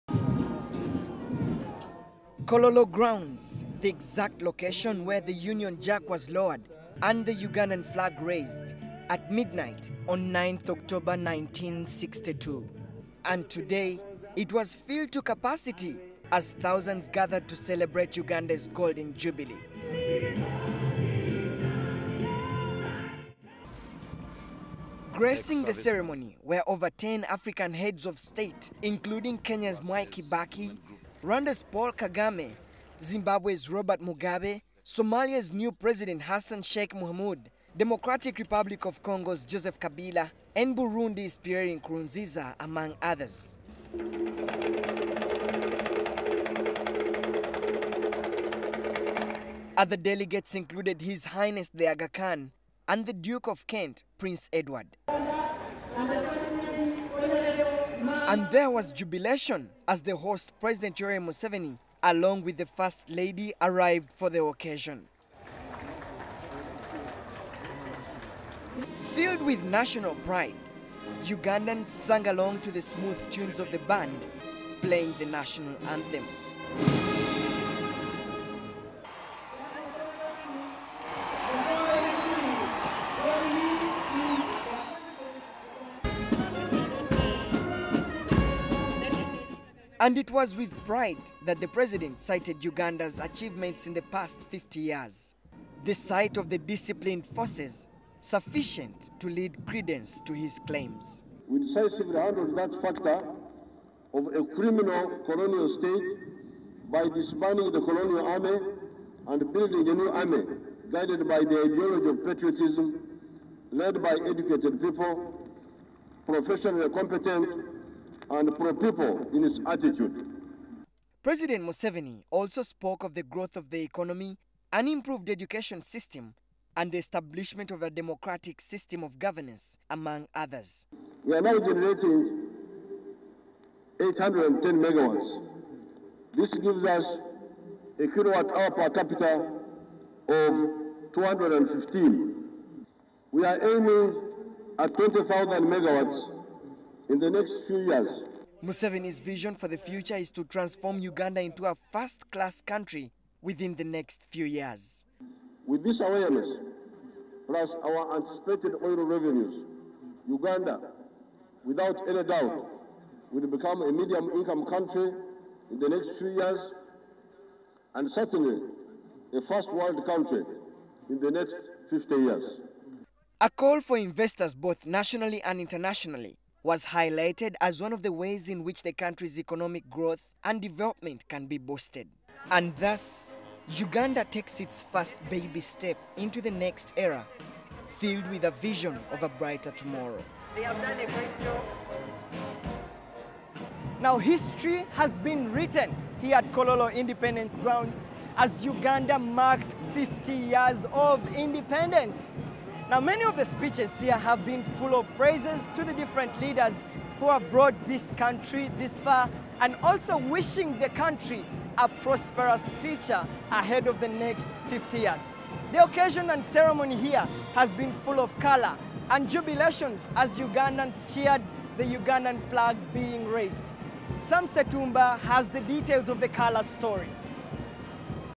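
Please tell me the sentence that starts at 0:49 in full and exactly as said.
Other delegates included His Highness the Aga Khan and the Duke of Kent, Prince Edward.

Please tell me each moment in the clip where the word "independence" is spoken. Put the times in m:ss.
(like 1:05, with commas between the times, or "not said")
3:16, 3:21.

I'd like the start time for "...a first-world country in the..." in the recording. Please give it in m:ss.
2:49.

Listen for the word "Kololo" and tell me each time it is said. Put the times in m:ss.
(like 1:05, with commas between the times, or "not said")
0:02, 3:16.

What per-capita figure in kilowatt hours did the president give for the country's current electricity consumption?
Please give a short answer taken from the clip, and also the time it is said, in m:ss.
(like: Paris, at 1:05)
215, at 2:21.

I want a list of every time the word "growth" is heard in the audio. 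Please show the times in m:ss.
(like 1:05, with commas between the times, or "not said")
2:03, 2:59.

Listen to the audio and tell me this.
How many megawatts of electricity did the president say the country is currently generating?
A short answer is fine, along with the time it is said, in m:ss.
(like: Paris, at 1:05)
810, at 2:14.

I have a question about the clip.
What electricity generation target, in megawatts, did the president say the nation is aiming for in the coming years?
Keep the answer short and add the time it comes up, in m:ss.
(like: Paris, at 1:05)
20,000, at 2:24.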